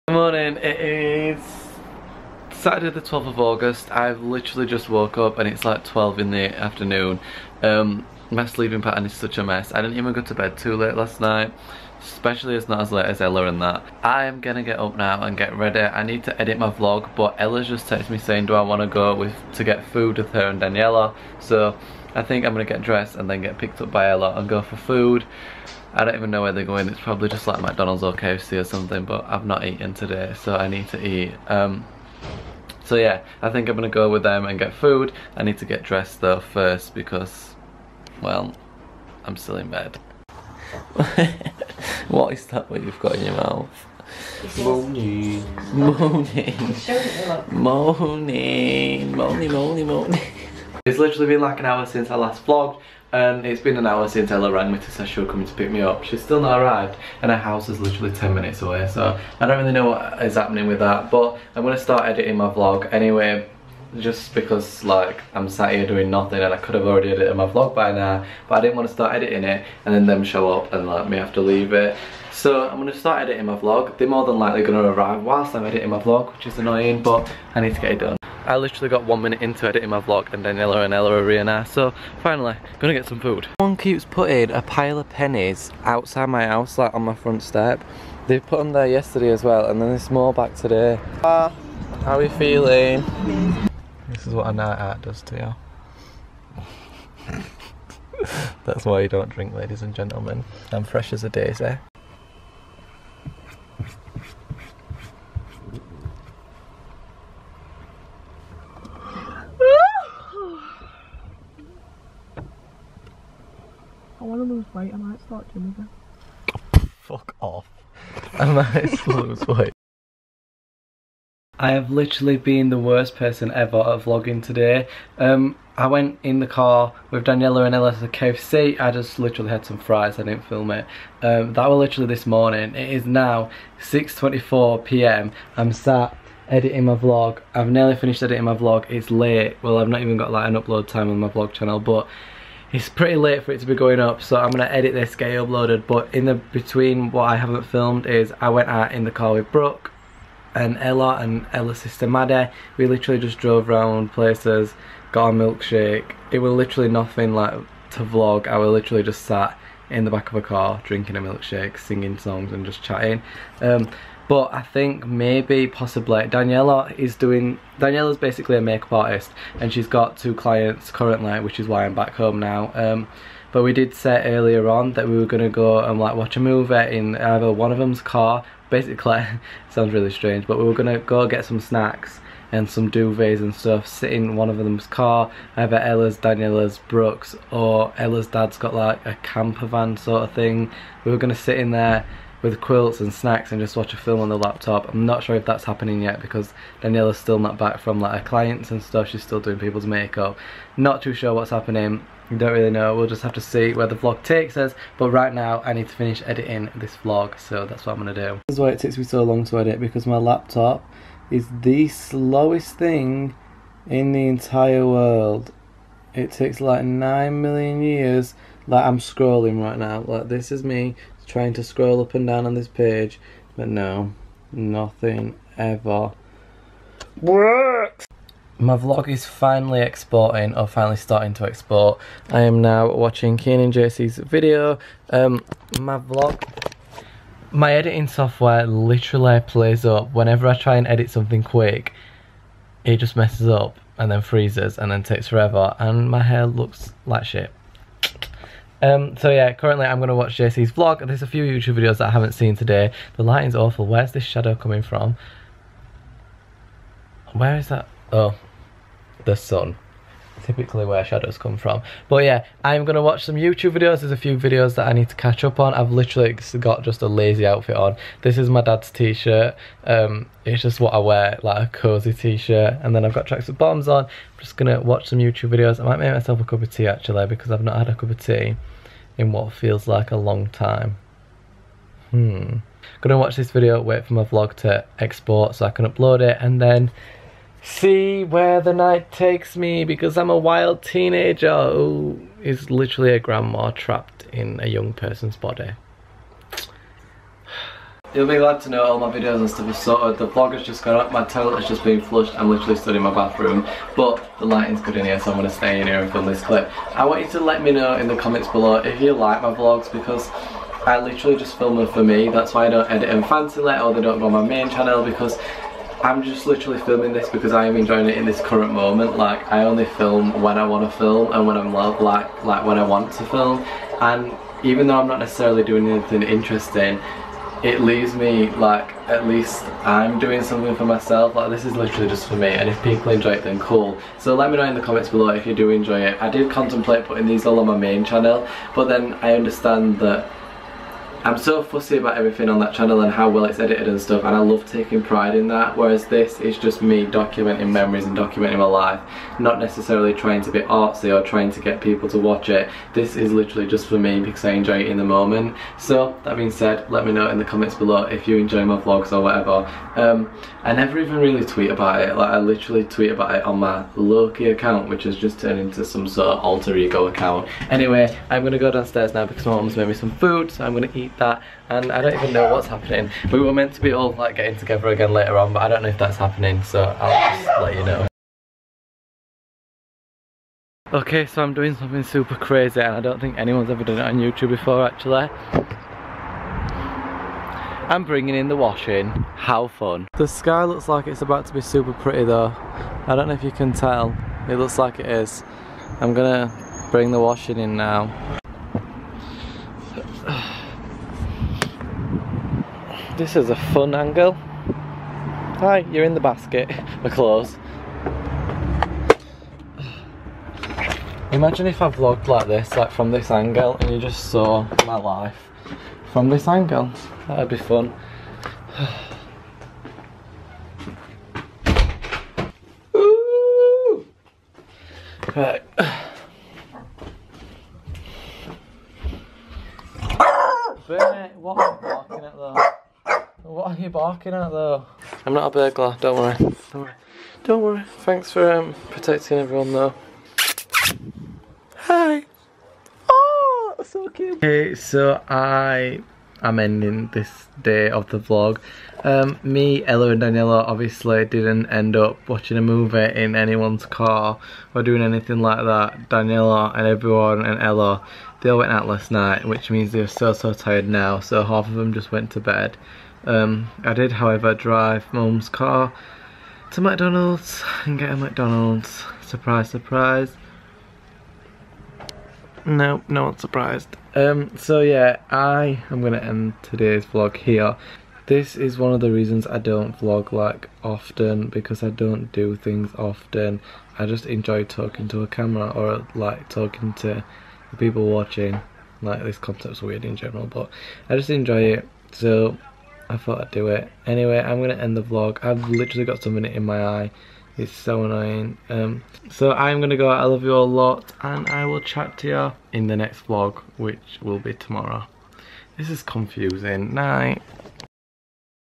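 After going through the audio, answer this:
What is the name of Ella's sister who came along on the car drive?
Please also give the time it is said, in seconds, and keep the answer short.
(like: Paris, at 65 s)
Maddie, at 152 s.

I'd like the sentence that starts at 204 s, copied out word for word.
But right now, I need to finish editing this vlog, so that's what I'm gonna do.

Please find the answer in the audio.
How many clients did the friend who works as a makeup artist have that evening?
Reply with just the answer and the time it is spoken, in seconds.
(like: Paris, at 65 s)
2, at 170 s.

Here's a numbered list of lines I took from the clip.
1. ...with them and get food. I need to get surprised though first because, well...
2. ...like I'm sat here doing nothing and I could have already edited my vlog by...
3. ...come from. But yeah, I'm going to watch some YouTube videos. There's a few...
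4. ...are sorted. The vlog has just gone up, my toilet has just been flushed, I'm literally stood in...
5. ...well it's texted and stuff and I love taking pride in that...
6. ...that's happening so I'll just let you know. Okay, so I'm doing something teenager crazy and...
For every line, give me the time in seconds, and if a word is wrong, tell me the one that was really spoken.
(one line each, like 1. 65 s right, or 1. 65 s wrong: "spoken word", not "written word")
1. 34 s wrong: "dressed", not "surprised"
2. 64 s right
3. 261 s right
4. 299 s right
5. 343 s wrong: "edited", not "texted"
6. 375 s wrong: "super", not "teenager".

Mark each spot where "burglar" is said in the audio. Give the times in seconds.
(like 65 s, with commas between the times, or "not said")
435 s.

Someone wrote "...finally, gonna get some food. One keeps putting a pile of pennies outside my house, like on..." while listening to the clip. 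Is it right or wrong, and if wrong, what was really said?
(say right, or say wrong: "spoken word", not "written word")
right.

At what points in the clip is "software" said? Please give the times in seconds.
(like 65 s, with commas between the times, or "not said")
238 s.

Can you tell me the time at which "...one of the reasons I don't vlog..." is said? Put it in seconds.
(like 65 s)
478 s.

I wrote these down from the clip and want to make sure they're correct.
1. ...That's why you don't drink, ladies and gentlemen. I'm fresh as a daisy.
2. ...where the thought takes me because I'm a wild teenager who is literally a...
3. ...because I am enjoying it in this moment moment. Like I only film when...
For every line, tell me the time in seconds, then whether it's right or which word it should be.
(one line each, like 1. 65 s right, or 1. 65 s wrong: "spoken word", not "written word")
1. 98 s right
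2. 288 s wrong: "night", not "thought"
3. 317 s wrong: "current", not "moment".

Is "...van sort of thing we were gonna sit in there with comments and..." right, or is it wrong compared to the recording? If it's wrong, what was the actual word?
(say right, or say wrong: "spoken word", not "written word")
wrong: "quilts", not "comments".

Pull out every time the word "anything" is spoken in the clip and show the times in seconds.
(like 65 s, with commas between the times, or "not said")
325 s, 455 s.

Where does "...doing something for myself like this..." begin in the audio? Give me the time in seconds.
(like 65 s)
330 s.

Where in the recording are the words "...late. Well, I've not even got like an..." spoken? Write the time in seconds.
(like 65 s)
139 s.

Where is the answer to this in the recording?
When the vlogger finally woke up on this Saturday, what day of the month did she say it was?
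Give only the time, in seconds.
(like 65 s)
2 s.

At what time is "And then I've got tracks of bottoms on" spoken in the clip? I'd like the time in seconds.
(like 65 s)
272 s.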